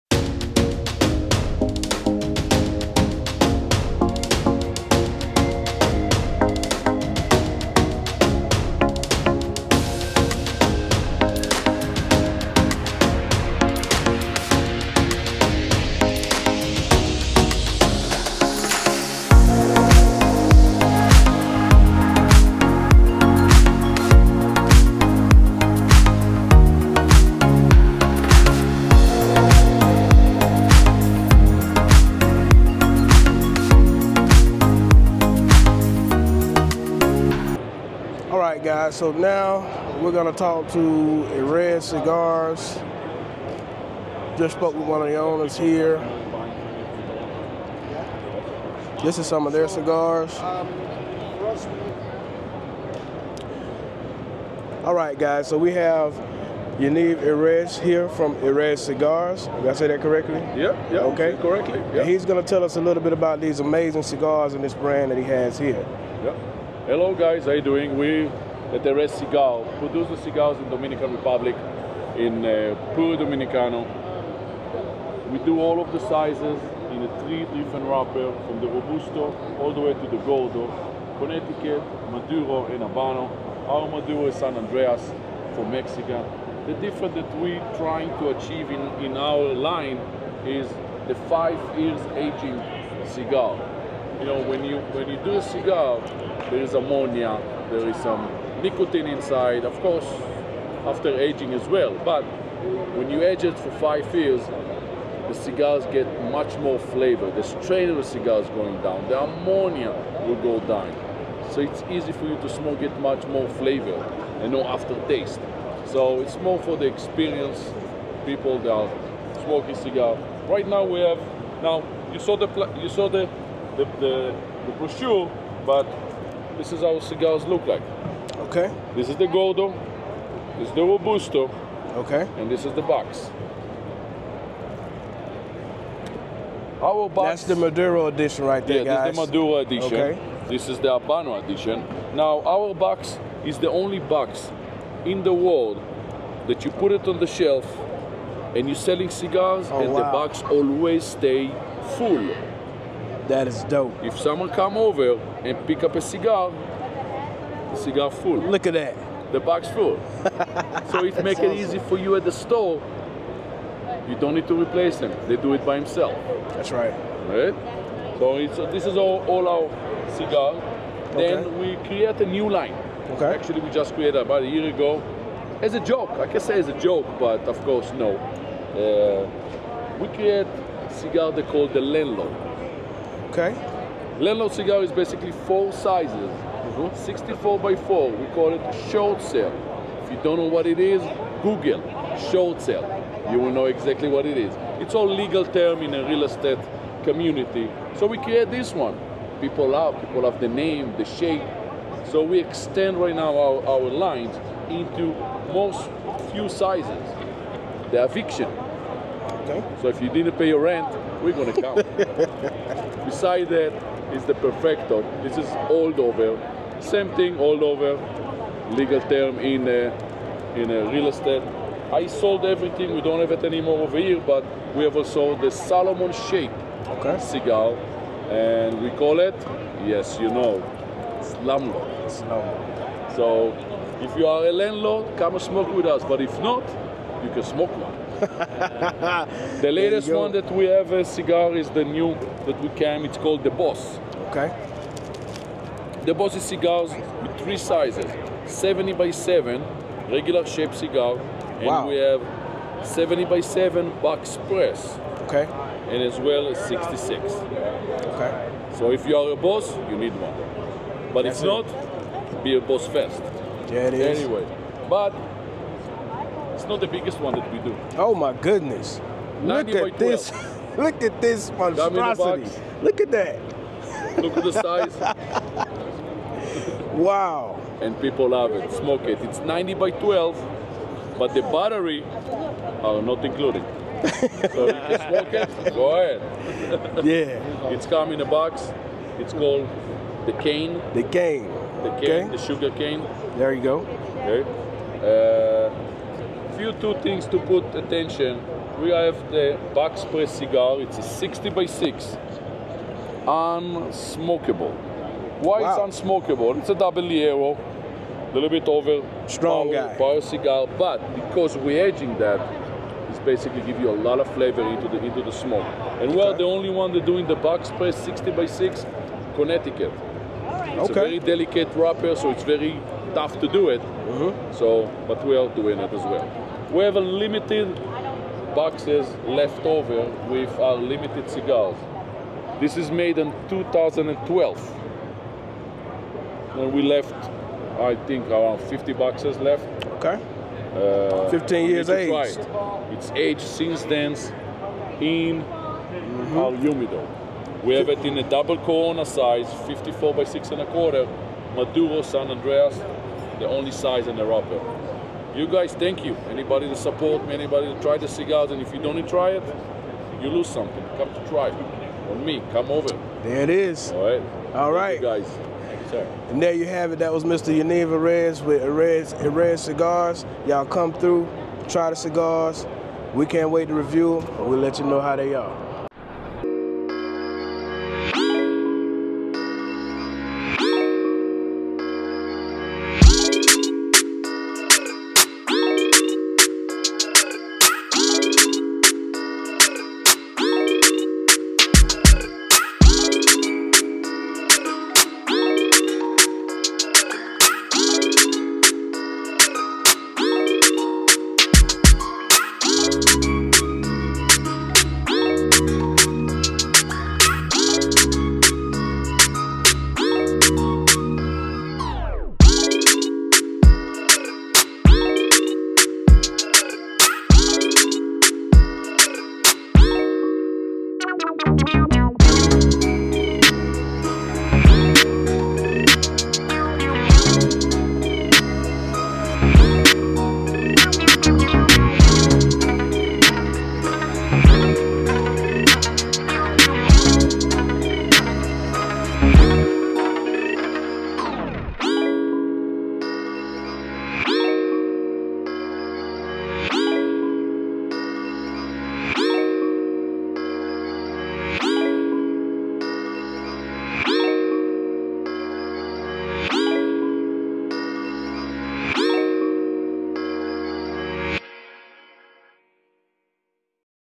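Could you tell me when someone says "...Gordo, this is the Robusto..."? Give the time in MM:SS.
02:09.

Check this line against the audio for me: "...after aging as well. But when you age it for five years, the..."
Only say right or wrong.
right.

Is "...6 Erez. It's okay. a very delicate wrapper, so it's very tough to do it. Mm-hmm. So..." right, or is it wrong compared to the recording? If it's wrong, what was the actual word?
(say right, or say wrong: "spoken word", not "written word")
wrong: "Connecticut", not "Erez".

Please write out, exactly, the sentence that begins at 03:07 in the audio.
64 by 4, we call it short sale.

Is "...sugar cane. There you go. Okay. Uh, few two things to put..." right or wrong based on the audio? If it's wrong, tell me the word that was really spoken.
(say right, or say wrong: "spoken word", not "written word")
right.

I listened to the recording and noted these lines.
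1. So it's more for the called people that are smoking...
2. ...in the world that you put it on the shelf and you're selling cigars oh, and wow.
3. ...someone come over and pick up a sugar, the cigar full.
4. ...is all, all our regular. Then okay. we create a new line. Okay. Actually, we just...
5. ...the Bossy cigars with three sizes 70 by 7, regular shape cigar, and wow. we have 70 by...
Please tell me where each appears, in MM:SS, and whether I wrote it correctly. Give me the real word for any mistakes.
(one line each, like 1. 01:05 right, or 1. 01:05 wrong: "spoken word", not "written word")
1. 01:55 wrong: "experienced", not "called"
2. 02:25 right
3. 02:34 wrong: "cigar", not "sugar"
4. 02:48 wrong: "cigar", not "regular"
5. 04:06 right.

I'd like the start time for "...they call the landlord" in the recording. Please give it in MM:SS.
03:01.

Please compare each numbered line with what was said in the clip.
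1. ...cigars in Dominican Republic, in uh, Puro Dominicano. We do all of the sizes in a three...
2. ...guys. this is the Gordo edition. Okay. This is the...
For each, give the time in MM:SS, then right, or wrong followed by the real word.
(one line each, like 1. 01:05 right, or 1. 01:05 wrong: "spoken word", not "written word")
1. 01:10 right
2. 02:19 wrong: "Maduro", not "Gordo".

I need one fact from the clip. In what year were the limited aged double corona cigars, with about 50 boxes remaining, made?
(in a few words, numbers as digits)
2012.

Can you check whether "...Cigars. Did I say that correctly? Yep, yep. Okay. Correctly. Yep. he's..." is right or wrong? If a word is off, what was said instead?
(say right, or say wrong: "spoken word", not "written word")
right.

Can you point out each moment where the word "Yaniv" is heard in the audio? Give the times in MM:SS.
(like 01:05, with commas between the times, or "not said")
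00:56, 06:07.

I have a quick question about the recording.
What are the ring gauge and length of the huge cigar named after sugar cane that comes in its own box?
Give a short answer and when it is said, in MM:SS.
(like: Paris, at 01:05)
90 by 12, at 04:39.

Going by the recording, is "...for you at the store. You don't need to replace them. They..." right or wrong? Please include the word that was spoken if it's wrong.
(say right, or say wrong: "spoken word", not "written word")
right.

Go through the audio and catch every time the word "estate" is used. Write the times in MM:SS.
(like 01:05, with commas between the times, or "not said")
03:16, 03:41.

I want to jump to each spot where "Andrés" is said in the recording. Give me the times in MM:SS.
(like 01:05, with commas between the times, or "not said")
01:24, 05:52.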